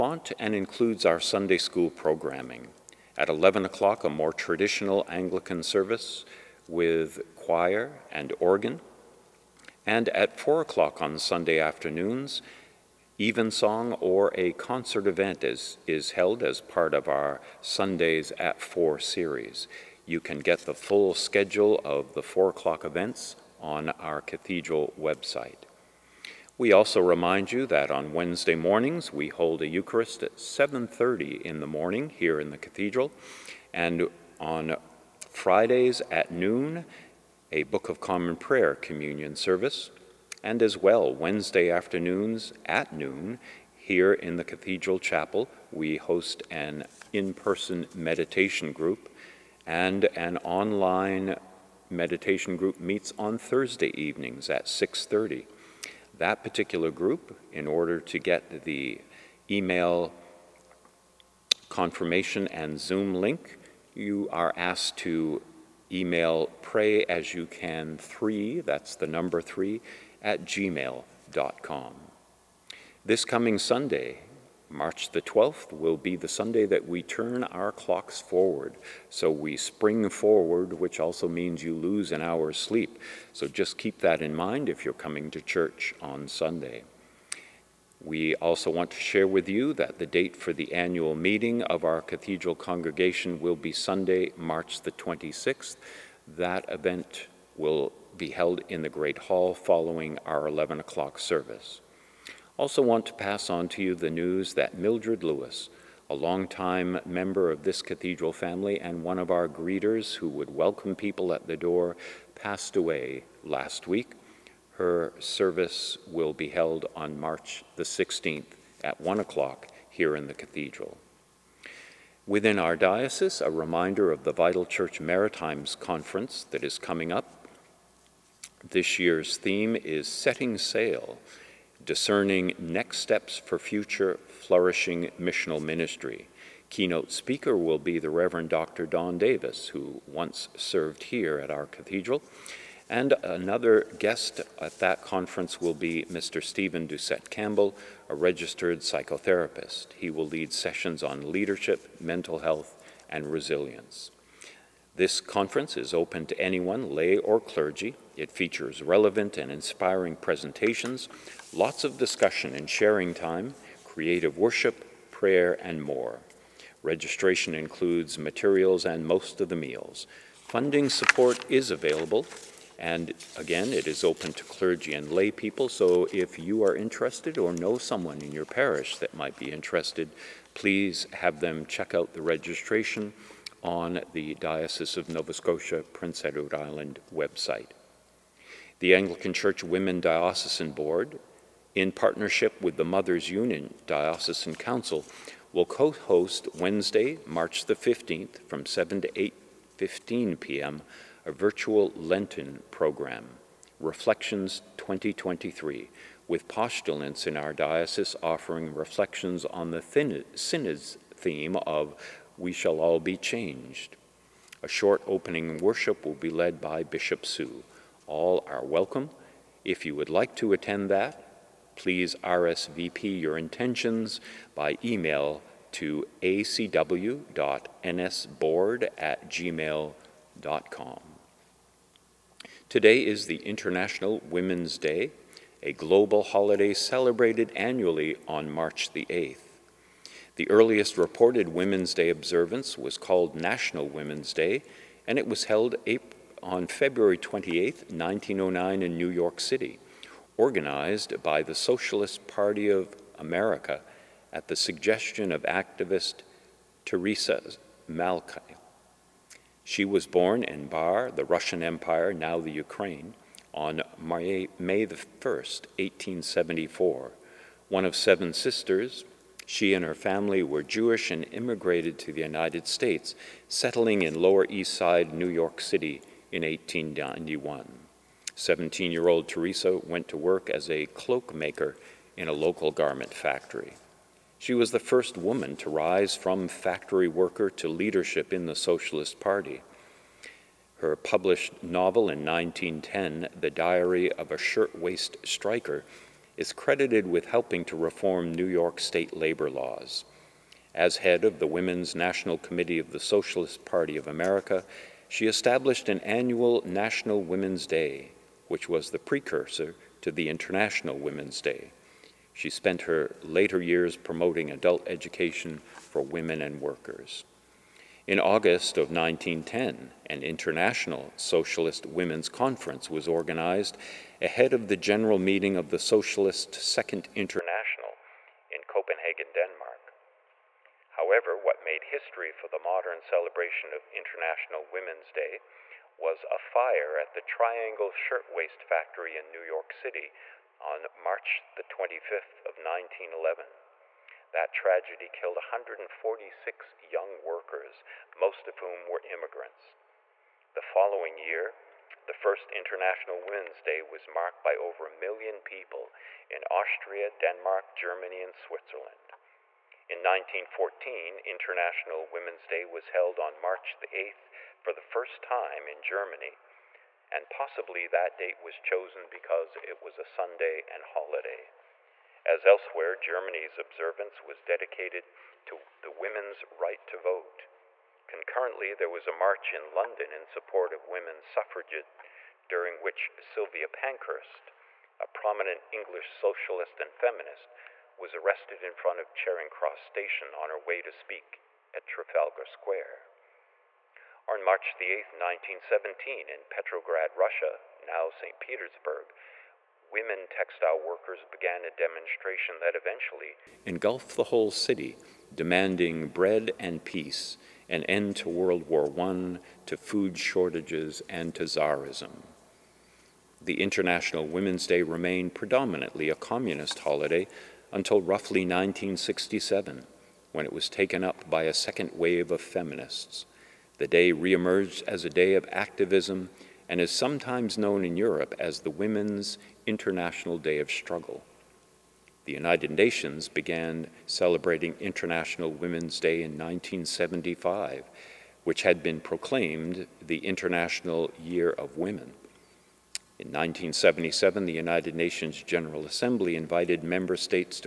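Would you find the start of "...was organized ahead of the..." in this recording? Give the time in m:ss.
5:22.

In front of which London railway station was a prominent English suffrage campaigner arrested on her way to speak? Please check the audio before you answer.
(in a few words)
Charing Cross Station.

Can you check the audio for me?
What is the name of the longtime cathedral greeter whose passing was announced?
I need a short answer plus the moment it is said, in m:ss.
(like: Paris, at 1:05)
Mildred Lewis, at 1:44.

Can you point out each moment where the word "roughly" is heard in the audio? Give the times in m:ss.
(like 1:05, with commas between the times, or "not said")
6:58.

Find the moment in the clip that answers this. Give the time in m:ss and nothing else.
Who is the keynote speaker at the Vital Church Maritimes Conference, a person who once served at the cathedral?
2:18.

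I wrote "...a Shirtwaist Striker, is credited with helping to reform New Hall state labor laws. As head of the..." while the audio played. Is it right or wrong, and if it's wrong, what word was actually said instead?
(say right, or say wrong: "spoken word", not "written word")
wrong: "York", not "Hall".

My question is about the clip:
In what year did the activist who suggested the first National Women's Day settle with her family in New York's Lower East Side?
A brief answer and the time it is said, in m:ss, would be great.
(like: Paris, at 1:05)
1891, at 4:36.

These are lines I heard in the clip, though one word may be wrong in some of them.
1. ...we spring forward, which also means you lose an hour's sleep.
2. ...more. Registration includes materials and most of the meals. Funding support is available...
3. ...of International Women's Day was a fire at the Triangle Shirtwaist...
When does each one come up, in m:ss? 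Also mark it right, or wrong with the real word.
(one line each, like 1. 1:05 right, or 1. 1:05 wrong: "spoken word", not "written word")
1. 1:19 right
2. 2:45 right
3. 5:33 right.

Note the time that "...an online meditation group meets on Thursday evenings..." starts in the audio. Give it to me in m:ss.
0:50.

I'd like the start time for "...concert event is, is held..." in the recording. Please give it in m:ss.
0:14.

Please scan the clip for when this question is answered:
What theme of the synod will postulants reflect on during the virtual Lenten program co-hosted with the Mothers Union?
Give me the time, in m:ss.
3:32.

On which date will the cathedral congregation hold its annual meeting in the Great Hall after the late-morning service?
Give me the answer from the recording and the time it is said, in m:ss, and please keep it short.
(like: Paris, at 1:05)
March 26, at 1:33.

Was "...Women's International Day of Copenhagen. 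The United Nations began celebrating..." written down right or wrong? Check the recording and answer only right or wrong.
wrong.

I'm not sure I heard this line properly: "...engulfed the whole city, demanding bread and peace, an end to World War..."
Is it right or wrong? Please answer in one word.
right.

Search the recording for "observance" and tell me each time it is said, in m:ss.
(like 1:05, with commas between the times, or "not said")
4:02, 6:13.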